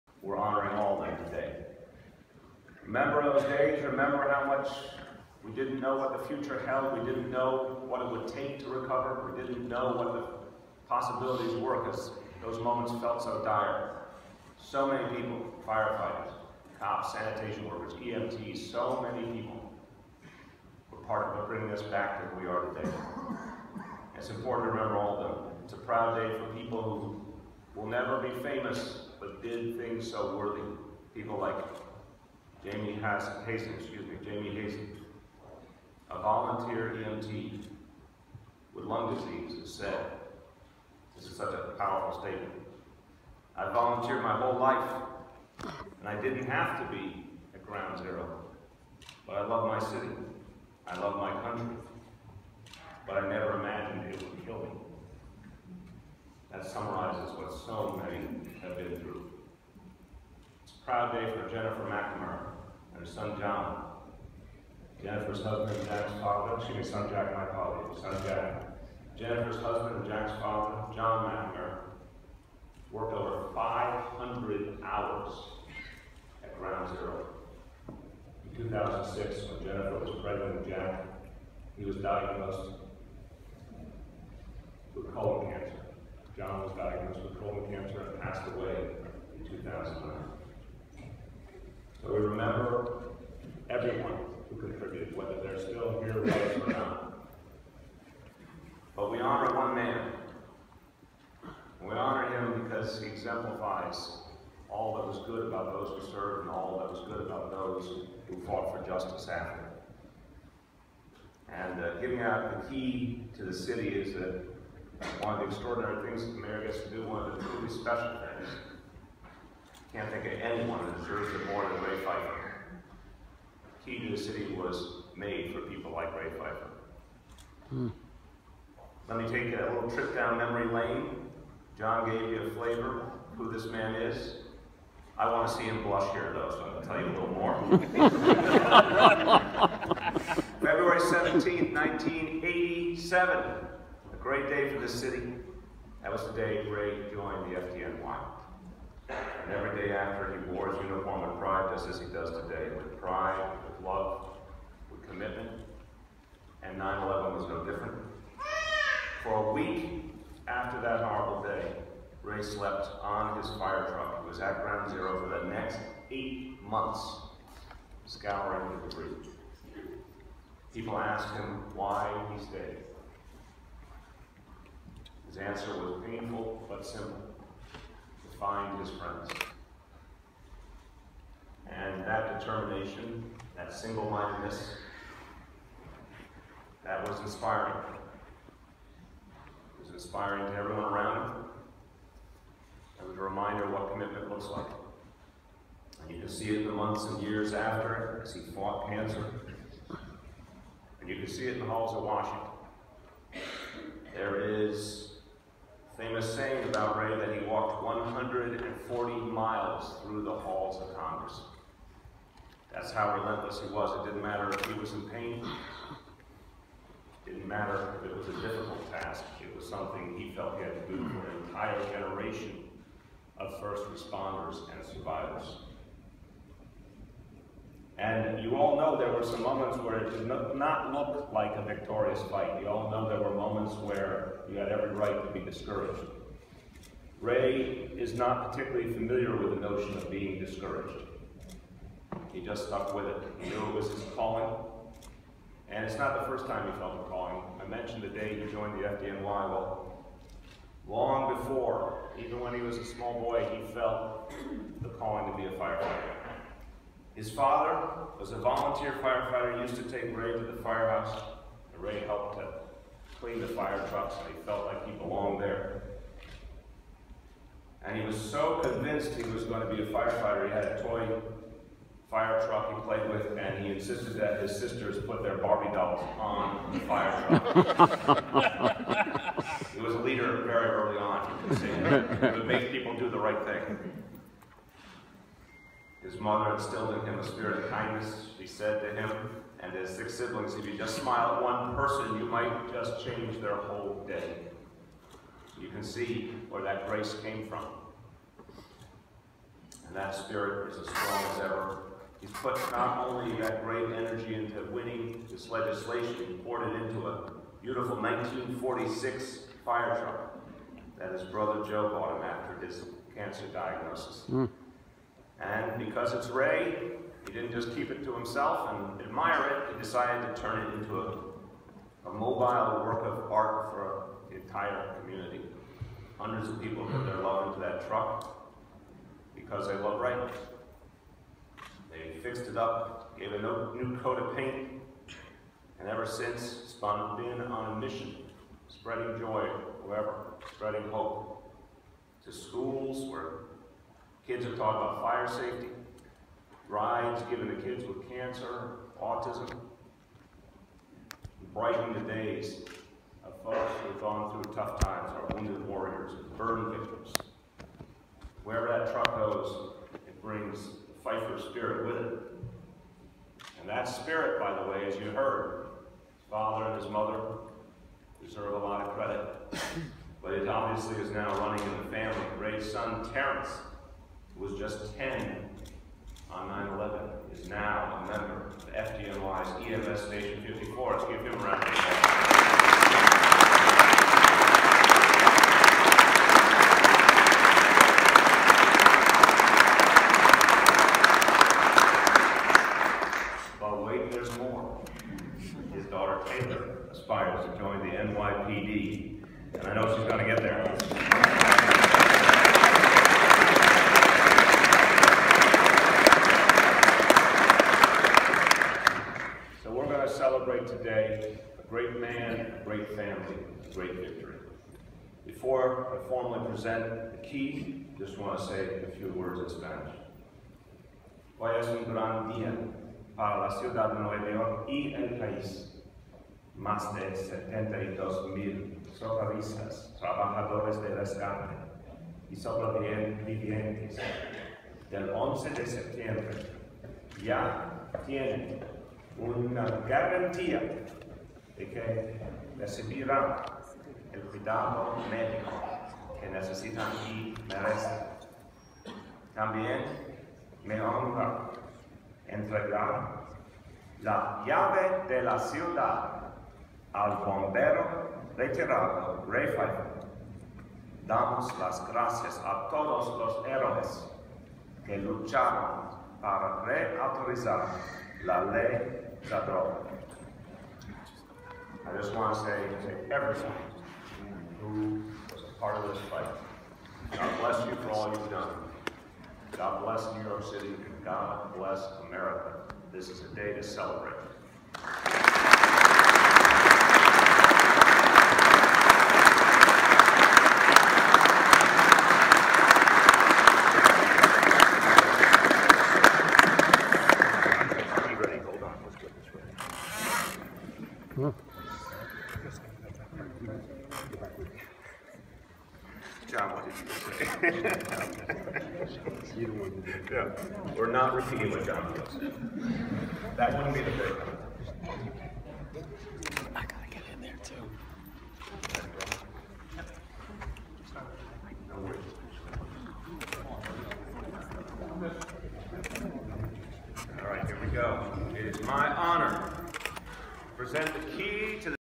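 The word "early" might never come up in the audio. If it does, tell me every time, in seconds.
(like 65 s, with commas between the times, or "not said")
280 s.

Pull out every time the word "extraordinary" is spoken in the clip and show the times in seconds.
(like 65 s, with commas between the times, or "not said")
115 s.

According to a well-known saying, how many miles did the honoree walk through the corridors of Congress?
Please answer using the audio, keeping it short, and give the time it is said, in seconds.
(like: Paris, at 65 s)
140, at 207 s.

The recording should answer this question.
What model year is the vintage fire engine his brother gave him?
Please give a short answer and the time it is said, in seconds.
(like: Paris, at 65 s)
1946, at 307 s.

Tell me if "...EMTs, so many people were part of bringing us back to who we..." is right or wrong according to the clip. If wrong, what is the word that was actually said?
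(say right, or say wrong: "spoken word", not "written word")
right.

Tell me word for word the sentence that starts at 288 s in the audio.
She said to him, and his six siblings, if you just smile at one person, you might just change their whole day.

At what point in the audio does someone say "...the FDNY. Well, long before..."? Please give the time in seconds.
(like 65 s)
248 s.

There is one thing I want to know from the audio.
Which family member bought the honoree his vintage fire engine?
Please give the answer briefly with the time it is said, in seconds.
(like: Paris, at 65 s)
Joe, at 311 s.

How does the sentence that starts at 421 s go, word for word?
Hoy es un gran día para la ciudad de Nueva York y el país.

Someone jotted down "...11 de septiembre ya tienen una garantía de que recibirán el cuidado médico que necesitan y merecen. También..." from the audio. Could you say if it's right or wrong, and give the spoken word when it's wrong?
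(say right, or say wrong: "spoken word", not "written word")
right.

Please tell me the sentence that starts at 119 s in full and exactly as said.
Can't think of anyone that deserves it more than Ray Pfeifer.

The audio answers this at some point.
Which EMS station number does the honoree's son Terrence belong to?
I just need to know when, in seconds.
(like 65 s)
380 s.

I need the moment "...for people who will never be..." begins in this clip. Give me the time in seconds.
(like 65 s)
26 s.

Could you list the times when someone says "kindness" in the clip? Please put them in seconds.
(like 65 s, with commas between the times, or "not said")
287 s.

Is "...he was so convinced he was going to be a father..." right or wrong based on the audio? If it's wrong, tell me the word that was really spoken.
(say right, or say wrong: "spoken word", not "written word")
wrong: "firefighter", not "father".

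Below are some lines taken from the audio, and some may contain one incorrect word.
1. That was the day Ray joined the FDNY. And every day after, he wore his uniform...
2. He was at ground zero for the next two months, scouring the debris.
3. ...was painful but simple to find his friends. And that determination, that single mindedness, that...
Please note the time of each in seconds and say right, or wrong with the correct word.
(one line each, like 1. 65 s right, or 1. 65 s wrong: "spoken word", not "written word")
1. 146 s right
2. 164 s wrong: "eight", not "two"
3. 175 s right.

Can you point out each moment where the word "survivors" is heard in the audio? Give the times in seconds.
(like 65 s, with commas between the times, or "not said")
224 s.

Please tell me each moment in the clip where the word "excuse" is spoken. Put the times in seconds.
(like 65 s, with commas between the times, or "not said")
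33 s, 66 s.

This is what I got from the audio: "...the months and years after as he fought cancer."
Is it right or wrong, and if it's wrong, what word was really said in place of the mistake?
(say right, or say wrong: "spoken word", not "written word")
right.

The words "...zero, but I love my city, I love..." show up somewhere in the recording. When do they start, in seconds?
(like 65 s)
47 s.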